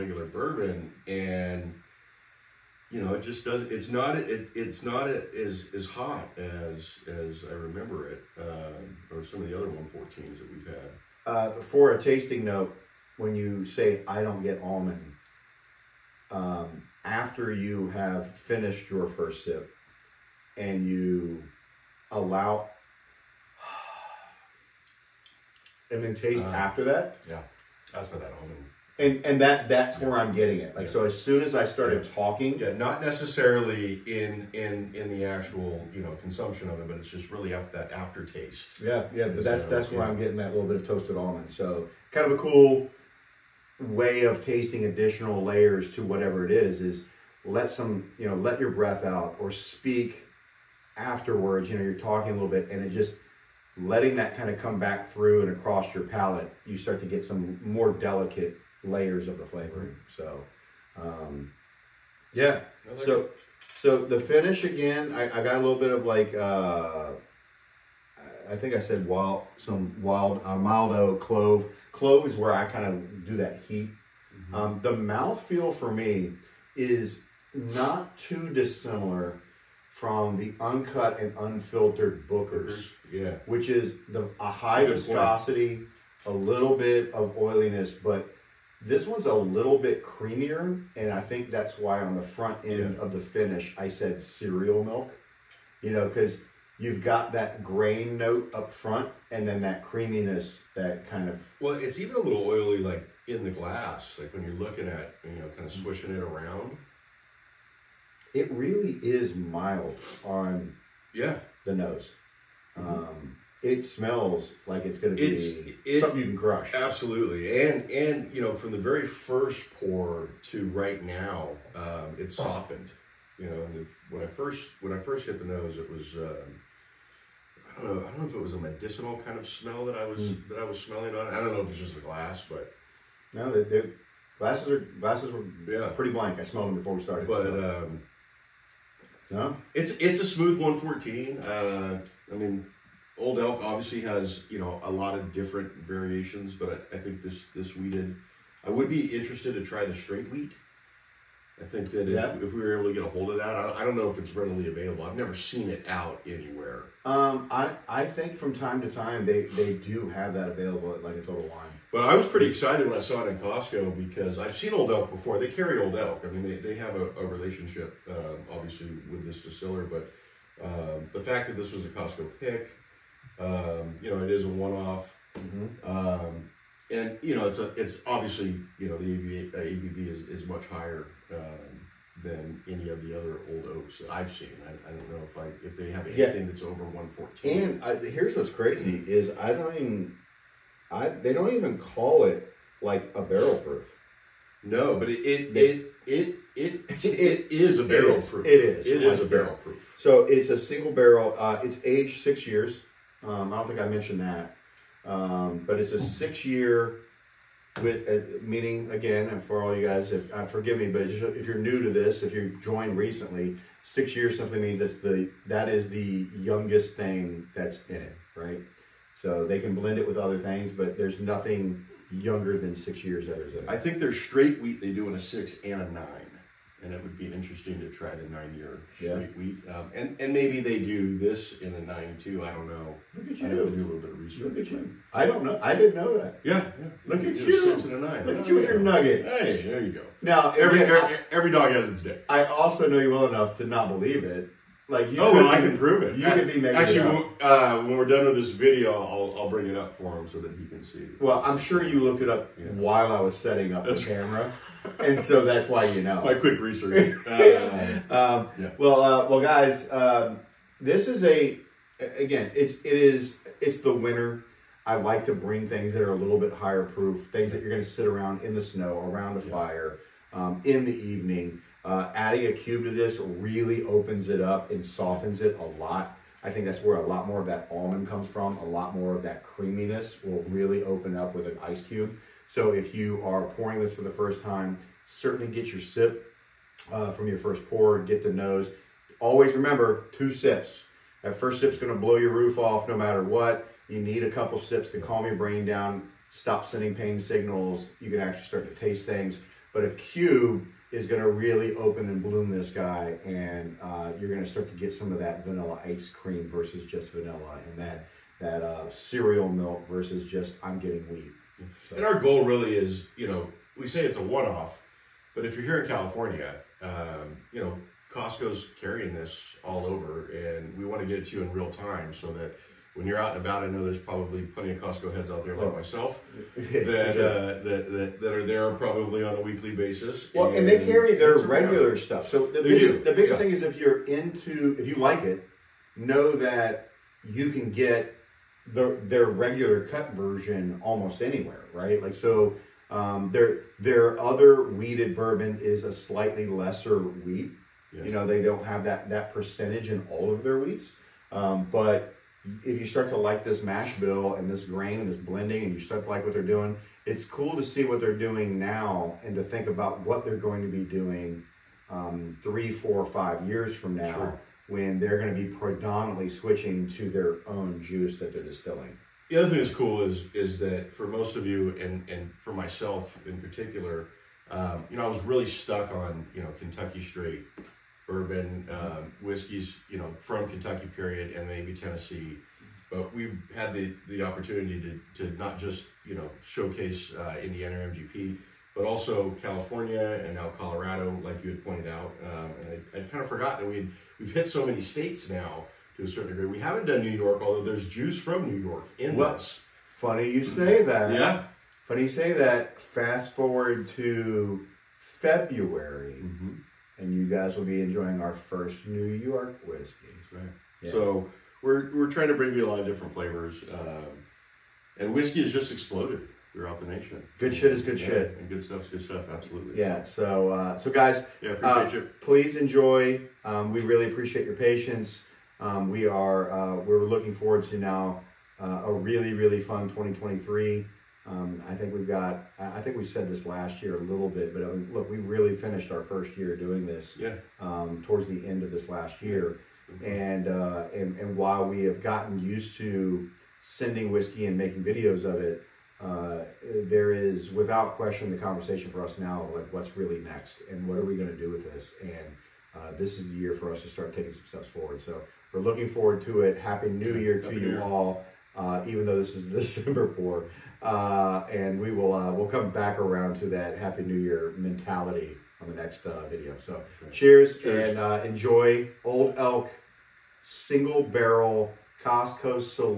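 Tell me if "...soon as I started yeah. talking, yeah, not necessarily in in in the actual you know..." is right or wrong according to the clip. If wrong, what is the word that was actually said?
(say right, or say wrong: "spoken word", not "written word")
right.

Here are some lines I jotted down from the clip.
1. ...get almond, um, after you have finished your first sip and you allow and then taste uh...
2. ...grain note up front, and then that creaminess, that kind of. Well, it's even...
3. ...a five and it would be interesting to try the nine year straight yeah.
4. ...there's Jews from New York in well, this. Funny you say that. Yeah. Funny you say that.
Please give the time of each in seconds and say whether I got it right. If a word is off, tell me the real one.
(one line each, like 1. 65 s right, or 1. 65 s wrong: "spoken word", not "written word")
1. 14 s right
2. 97 s right
3. 225 s wrong: "nine", not "five"
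4. 397 s right.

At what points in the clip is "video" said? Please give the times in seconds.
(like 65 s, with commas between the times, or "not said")
248 s, 444 s, 466 s.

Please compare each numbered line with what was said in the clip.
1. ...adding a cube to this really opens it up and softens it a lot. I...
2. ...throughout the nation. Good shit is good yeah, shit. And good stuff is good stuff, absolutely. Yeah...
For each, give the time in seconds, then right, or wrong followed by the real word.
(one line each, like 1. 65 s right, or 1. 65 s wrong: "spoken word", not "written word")
1. 272 s right
2. 416 s right.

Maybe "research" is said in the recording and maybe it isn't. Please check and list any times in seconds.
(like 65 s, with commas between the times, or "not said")
234 s, 256 s.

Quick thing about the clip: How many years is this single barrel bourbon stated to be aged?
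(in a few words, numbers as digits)
6 years.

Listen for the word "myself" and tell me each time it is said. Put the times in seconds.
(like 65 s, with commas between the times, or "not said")
325 s, 372 s.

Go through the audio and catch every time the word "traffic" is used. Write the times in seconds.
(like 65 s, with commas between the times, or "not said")
not said.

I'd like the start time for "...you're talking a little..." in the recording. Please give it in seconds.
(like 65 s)
51 s.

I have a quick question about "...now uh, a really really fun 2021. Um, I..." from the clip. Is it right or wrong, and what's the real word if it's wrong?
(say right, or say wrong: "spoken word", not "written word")
wrong: "2023", not "2021".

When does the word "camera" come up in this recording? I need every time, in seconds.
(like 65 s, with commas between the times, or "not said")
254 s.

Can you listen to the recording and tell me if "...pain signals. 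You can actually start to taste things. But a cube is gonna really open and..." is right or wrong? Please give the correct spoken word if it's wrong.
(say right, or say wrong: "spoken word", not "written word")
right.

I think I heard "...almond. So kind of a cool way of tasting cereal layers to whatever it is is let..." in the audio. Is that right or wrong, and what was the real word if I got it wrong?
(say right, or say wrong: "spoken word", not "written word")
wrong: "additional", not "cereal".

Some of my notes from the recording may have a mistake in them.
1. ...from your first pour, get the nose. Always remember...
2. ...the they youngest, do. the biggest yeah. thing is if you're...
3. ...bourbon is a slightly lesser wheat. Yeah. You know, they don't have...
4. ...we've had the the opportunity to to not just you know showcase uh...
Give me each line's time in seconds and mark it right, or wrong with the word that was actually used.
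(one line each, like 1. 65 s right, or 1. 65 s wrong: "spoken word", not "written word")
1. 287 s right
2. 332 s wrong: "biggest", not "youngest"
3. 345 s right
4. 383 s right.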